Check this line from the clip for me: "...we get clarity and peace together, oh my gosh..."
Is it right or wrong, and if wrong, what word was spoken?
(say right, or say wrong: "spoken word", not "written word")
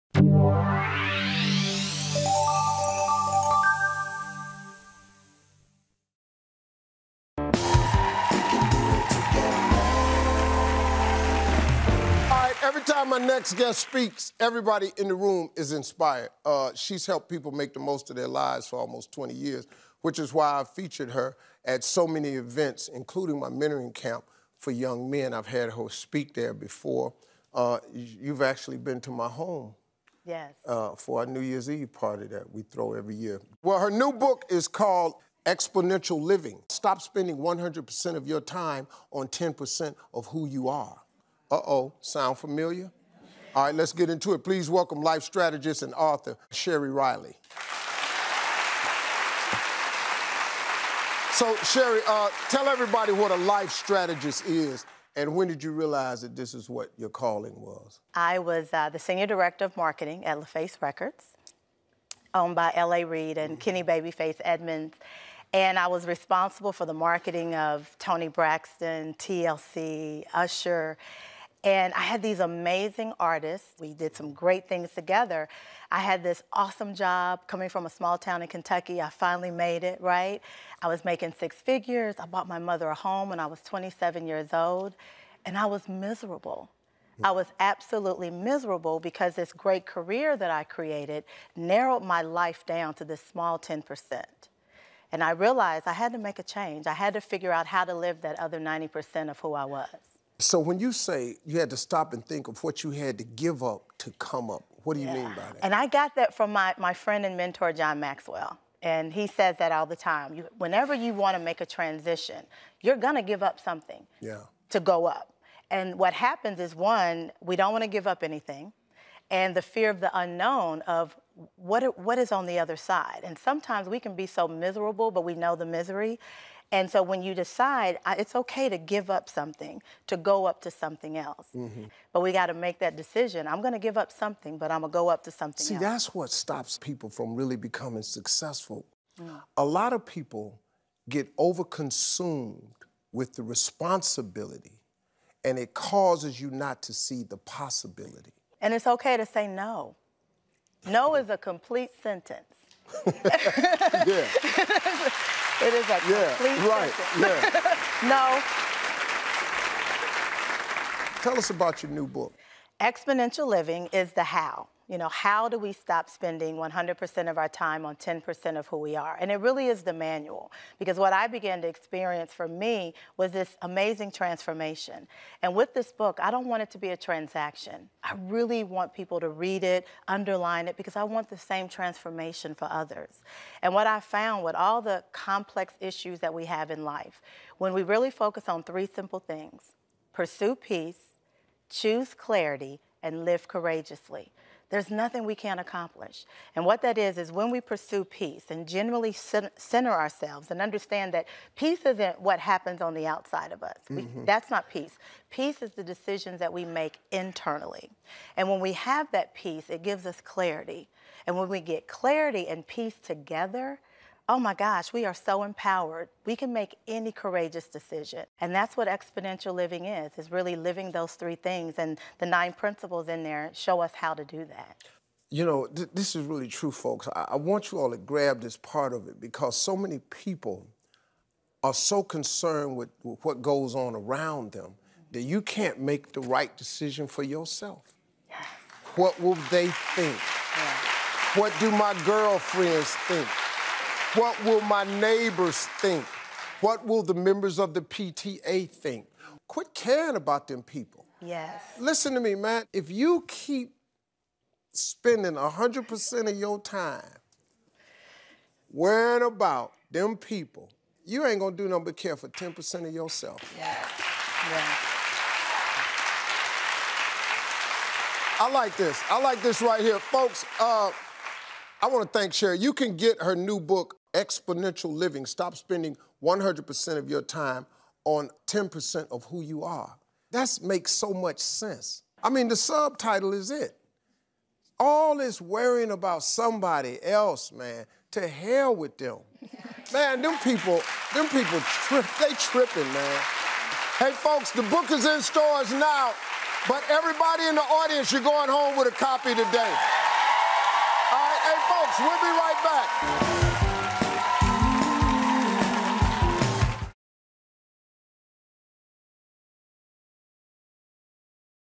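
right.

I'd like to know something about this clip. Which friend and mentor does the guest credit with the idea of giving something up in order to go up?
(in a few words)
John Maxwell.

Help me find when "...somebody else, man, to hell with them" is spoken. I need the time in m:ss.
4:46.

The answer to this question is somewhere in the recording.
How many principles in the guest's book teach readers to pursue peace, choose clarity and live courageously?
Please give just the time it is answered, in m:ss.
3:42.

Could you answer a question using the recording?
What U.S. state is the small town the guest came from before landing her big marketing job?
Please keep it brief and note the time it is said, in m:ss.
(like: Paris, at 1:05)
Kentucky, at 1:18.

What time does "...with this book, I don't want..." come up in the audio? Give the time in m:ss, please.
2:55.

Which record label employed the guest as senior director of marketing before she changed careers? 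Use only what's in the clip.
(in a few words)
LaFace Records.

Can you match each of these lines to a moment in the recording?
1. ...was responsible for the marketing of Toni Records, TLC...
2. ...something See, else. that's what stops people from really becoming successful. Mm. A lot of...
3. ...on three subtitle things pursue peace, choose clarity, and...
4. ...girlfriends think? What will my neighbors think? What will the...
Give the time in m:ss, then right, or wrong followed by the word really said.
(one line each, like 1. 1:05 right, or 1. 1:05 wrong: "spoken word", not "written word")
1. 1:05 wrong: "Braxton", not "Records"
2. 2:15 right
3. 3:08 wrong: "simple", not "subtitle"
4. 4:02 right.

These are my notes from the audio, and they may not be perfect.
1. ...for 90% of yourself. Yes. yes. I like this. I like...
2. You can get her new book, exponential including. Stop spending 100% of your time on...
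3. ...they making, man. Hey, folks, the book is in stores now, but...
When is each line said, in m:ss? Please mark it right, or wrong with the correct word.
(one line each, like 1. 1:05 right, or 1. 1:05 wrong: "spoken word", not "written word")
1. 4:22 wrong: "10", not "90"
2. 4:32 wrong: "living", not "including"
3. 4:52 wrong: "tripping", not "making".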